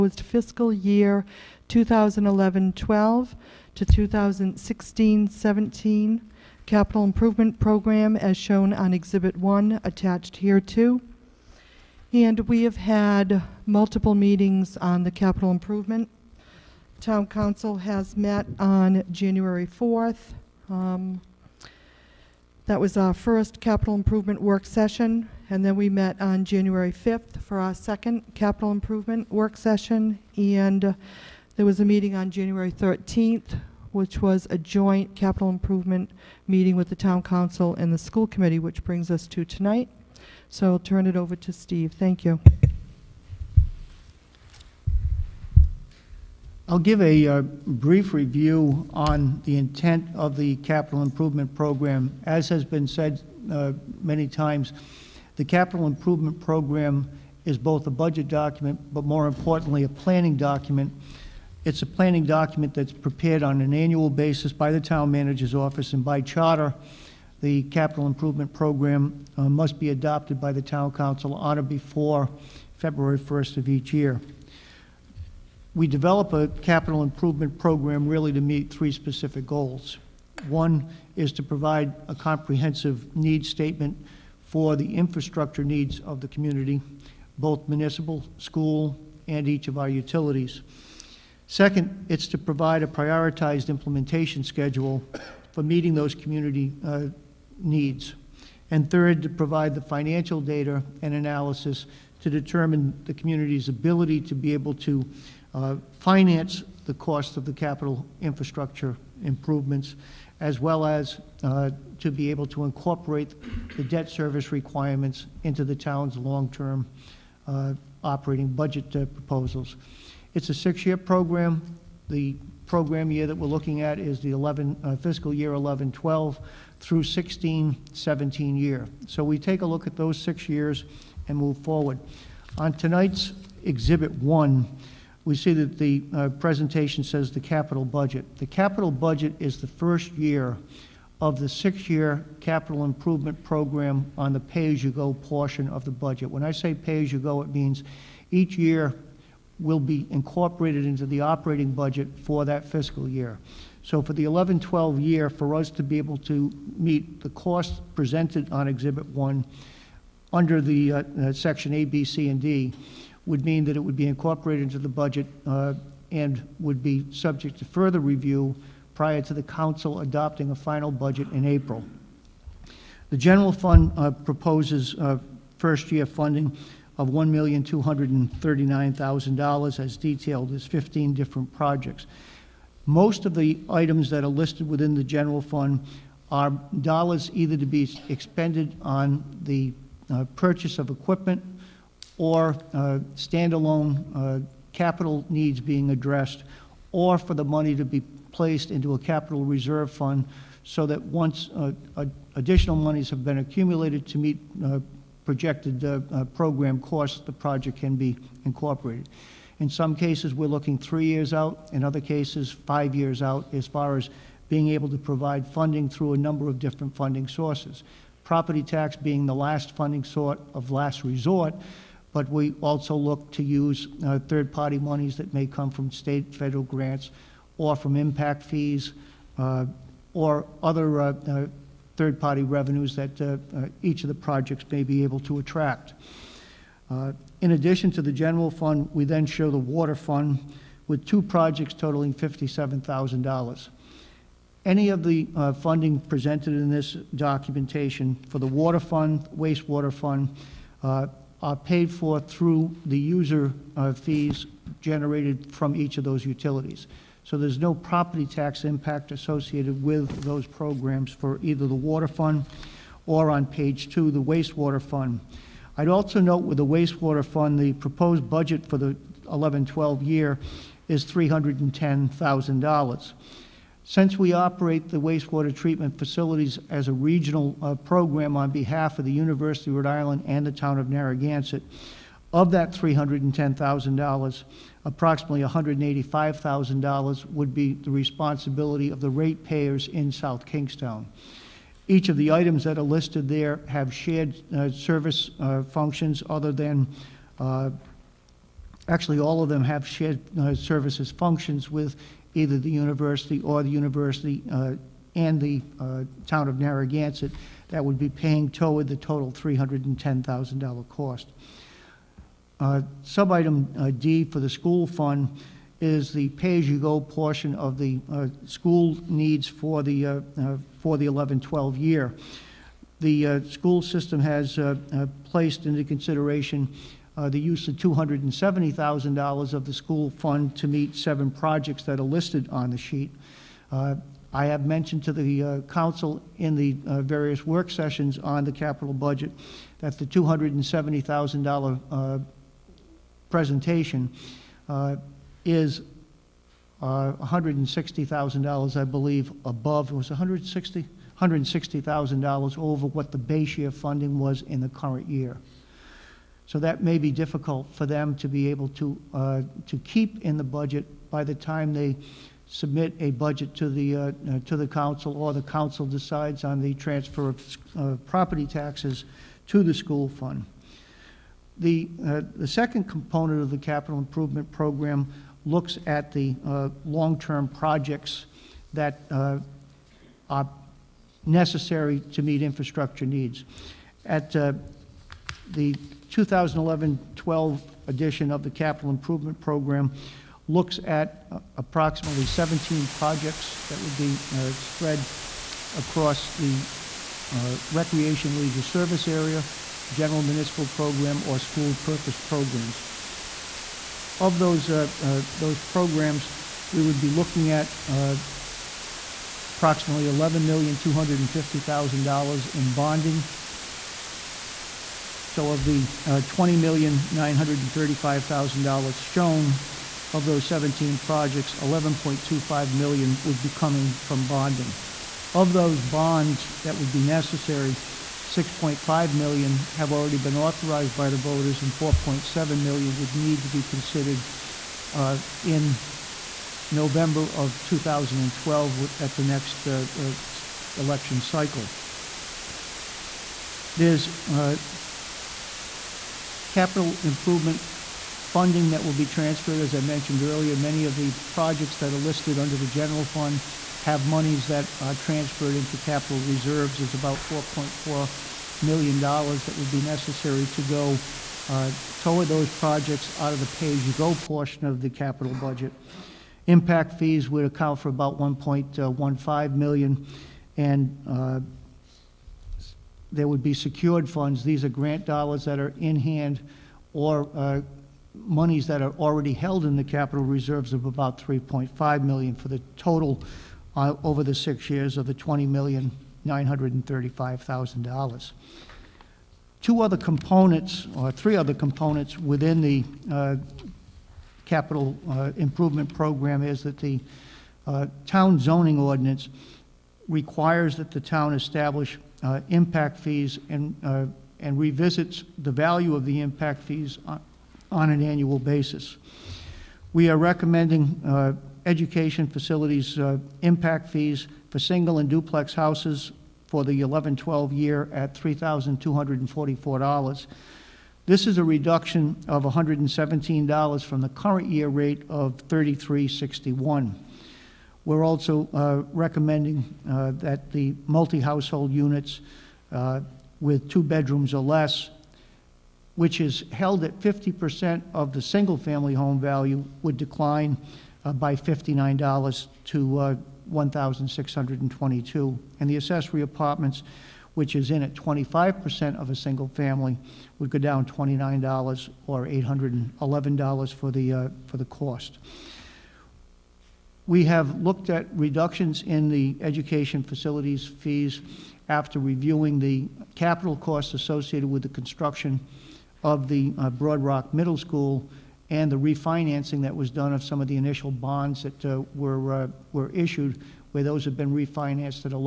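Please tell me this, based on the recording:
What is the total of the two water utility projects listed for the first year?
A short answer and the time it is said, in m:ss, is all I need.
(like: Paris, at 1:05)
$57,000, at 4:02.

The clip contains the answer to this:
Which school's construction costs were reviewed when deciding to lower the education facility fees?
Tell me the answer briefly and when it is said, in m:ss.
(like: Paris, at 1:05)
Broad Rock Middle School, at 9:26.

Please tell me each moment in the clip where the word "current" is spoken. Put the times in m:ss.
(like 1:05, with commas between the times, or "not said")
5:54, 8:44.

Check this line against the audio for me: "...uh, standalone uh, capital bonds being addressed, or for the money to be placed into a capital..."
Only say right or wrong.
wrong.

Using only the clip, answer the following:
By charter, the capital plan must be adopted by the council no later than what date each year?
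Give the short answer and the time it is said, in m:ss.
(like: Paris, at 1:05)
February 1st, at 1:12.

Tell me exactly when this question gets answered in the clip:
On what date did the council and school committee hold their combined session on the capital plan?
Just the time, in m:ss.
0:32.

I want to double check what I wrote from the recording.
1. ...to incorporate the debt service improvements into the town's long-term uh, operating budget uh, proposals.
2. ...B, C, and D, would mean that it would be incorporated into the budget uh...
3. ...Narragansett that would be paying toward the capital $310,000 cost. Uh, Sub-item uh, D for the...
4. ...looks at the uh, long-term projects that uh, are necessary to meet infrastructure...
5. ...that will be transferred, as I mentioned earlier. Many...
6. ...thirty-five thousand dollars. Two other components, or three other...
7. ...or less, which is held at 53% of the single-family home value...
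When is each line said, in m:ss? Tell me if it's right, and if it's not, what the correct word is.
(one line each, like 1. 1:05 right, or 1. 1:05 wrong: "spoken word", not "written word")
1. 1:52 wrong: "requirements", not "improvements"
2. 2:41 right
3. 5:06 wrong: "total", not "capital"
4. 6:15 right
5. 7:28 right
6. 8:06 right
7. 8:54 wrong: "50", not "53".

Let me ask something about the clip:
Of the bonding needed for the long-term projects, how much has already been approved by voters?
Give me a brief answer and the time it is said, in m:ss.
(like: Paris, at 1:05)
6.5 million, at 7:08.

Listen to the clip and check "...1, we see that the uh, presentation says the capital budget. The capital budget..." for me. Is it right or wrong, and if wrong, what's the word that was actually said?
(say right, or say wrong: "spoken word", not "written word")
right.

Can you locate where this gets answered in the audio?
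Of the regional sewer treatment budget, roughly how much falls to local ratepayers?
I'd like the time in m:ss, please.
4:45.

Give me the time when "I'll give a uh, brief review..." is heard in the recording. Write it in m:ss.
0:46.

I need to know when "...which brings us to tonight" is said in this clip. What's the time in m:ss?
0:38.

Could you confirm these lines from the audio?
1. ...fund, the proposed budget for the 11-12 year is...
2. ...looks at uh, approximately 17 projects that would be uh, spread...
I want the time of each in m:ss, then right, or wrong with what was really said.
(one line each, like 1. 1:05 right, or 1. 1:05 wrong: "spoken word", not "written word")
1. 4:27 right
2. 6:30 right.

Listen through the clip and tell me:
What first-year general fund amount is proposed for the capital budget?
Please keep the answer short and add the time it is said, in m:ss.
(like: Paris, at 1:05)
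$1,239,000, at 2:57.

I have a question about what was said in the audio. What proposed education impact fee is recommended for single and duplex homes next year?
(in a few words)
$3,244.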